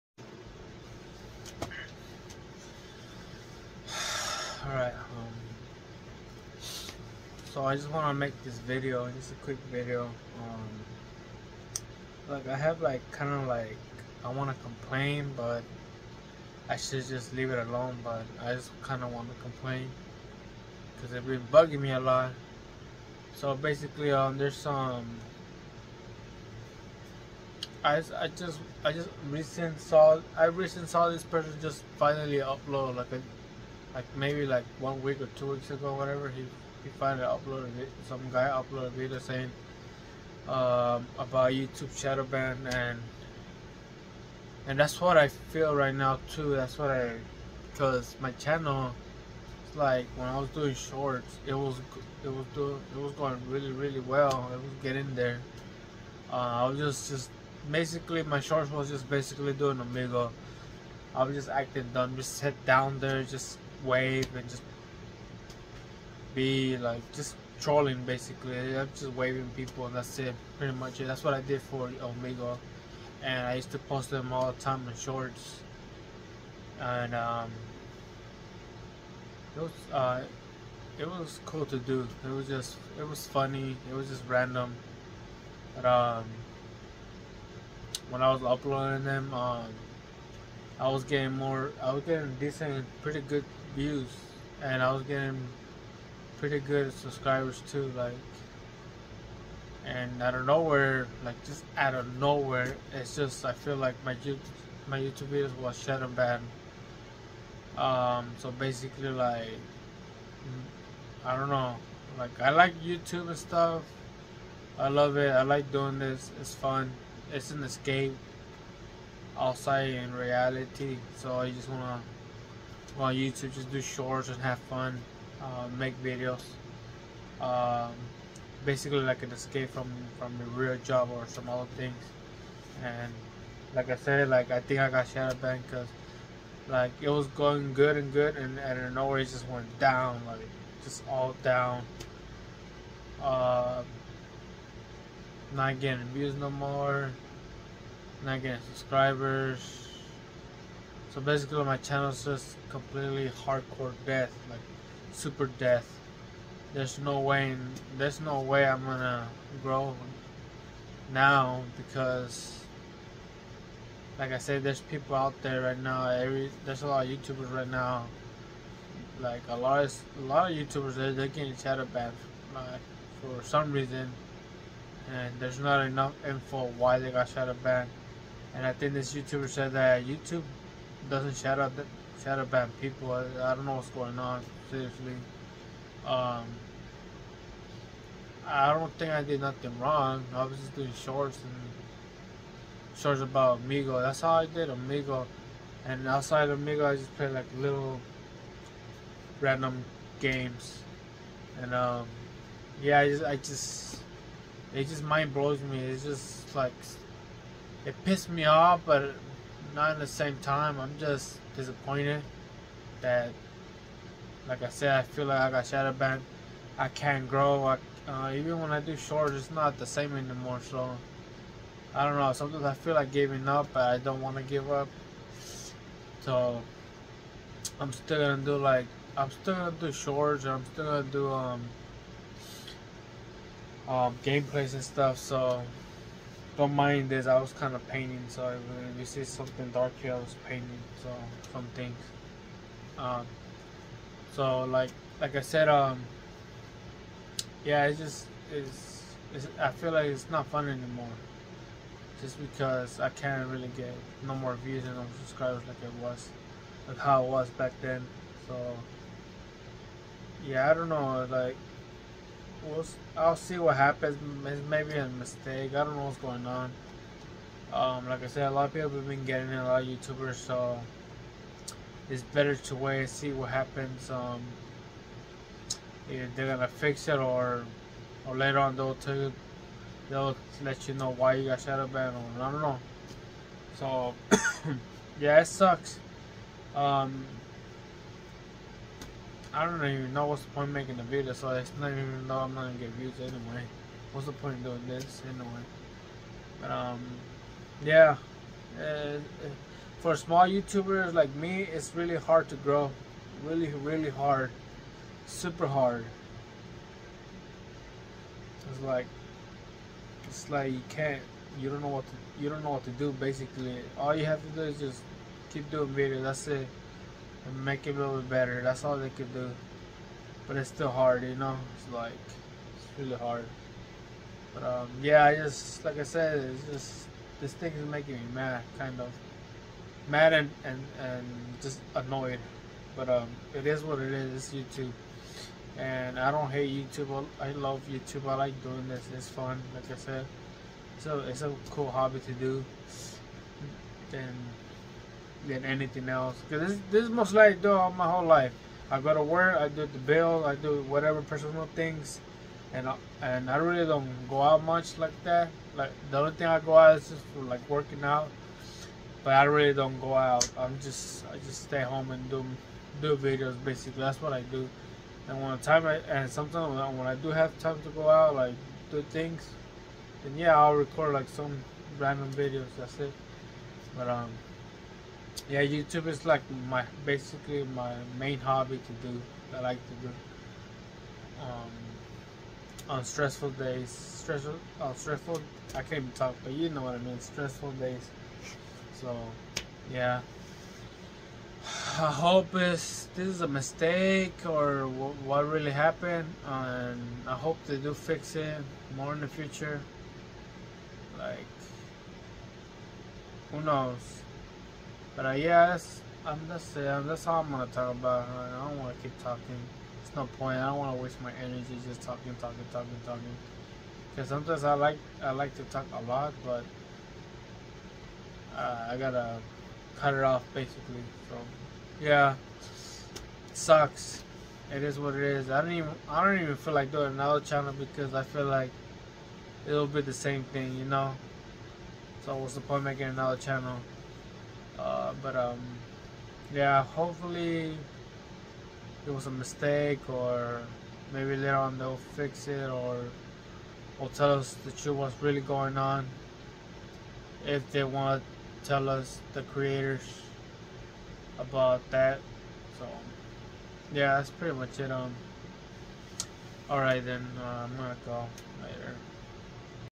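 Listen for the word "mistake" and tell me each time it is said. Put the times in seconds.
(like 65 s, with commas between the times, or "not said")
265 s, 393 s, 439 s.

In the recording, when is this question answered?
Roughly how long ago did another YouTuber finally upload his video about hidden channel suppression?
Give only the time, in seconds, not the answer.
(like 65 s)
34 s.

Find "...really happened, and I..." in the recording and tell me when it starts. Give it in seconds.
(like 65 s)
395 s.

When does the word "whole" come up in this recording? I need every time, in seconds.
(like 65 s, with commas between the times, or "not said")
348 s.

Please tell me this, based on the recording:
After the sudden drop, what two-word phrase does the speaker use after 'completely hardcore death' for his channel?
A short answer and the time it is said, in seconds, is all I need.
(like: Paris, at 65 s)
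super death, at 155 s.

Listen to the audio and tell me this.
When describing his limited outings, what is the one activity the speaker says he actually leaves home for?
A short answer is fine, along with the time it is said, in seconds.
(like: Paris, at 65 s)
working out, at 357 s.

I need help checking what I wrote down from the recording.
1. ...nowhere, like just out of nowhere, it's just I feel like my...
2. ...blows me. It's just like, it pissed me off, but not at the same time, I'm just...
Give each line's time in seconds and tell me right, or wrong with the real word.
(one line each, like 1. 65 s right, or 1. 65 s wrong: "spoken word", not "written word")
1. 100 s right
2. 205 s right.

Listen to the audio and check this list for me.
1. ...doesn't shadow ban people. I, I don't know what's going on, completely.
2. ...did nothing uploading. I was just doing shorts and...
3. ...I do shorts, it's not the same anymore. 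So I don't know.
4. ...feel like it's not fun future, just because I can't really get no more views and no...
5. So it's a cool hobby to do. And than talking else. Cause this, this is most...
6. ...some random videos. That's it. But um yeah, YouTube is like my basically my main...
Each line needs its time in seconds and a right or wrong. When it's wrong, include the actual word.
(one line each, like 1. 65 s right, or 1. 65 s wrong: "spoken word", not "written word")
1. 181 s wrong: "seriously", not "completely"
2. 189 s wrong: "wrong", not "uploading"
3. 218 s right
4. 249 s wrong: "anymore", not "future"
5. 340 s wrong: "anything", not "talking"
6. 371 s right.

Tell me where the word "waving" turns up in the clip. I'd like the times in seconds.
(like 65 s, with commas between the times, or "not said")
69 s.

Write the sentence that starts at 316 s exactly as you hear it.
That's it and make it a little bit better.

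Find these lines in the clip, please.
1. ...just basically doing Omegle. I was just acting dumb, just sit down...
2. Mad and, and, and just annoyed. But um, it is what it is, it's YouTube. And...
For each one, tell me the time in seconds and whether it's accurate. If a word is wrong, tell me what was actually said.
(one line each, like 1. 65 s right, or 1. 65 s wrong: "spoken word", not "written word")
1. 58 s right
2. 330 s right.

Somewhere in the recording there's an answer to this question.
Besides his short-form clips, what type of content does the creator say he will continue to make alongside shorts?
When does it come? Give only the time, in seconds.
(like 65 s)
234 s.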